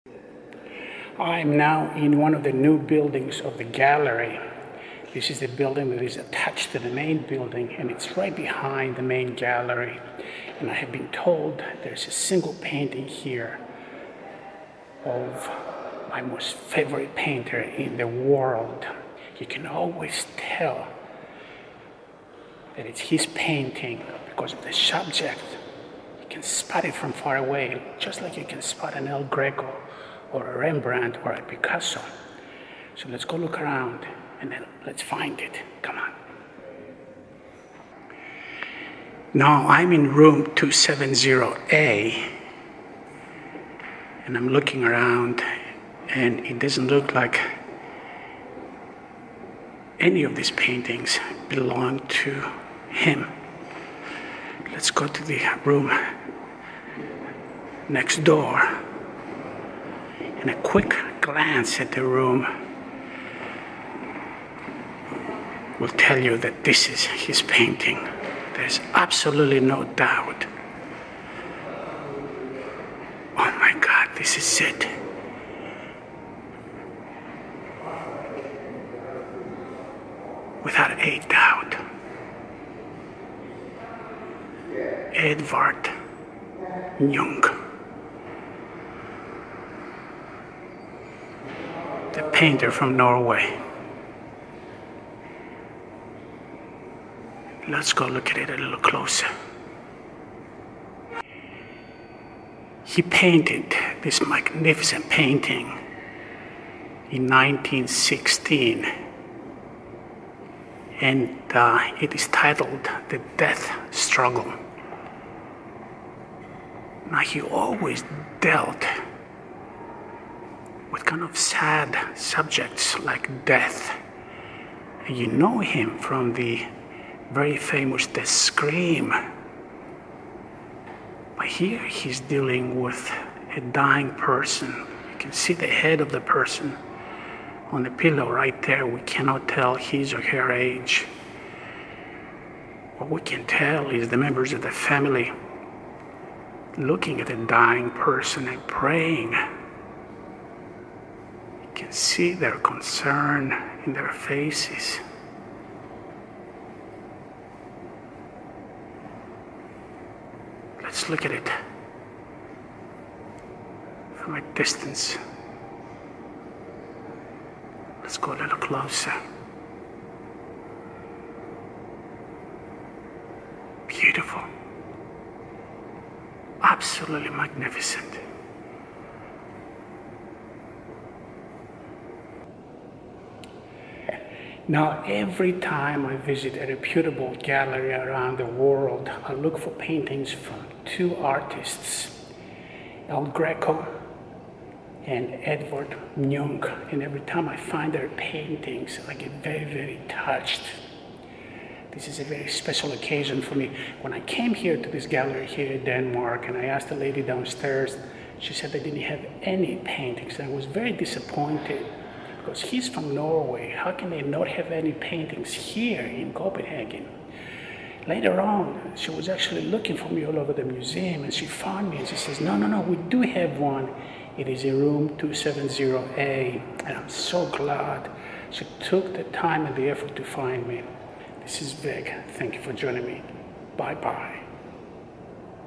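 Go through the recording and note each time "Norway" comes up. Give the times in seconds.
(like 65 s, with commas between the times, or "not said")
92 s, 213 s.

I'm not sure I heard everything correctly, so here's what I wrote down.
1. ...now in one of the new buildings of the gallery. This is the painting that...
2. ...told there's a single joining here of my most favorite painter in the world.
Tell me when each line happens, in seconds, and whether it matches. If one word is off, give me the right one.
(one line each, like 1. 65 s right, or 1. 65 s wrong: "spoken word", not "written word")
1. 1 s wrong: "building", not "painting"
2. 11 s wrong: "painting", not "joining".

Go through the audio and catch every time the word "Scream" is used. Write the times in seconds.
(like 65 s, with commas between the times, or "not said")
128 s.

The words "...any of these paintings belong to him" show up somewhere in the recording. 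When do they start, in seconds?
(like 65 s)
49 s.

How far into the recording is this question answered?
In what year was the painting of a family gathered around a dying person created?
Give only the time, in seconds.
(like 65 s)
107 s.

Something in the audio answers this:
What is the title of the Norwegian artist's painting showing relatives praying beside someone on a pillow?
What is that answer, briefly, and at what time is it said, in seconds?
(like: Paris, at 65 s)
The Death Struggle, at 113 s.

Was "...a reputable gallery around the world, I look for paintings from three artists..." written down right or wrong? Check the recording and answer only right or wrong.
wrong.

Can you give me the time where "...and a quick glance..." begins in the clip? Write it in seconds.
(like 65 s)
60 s.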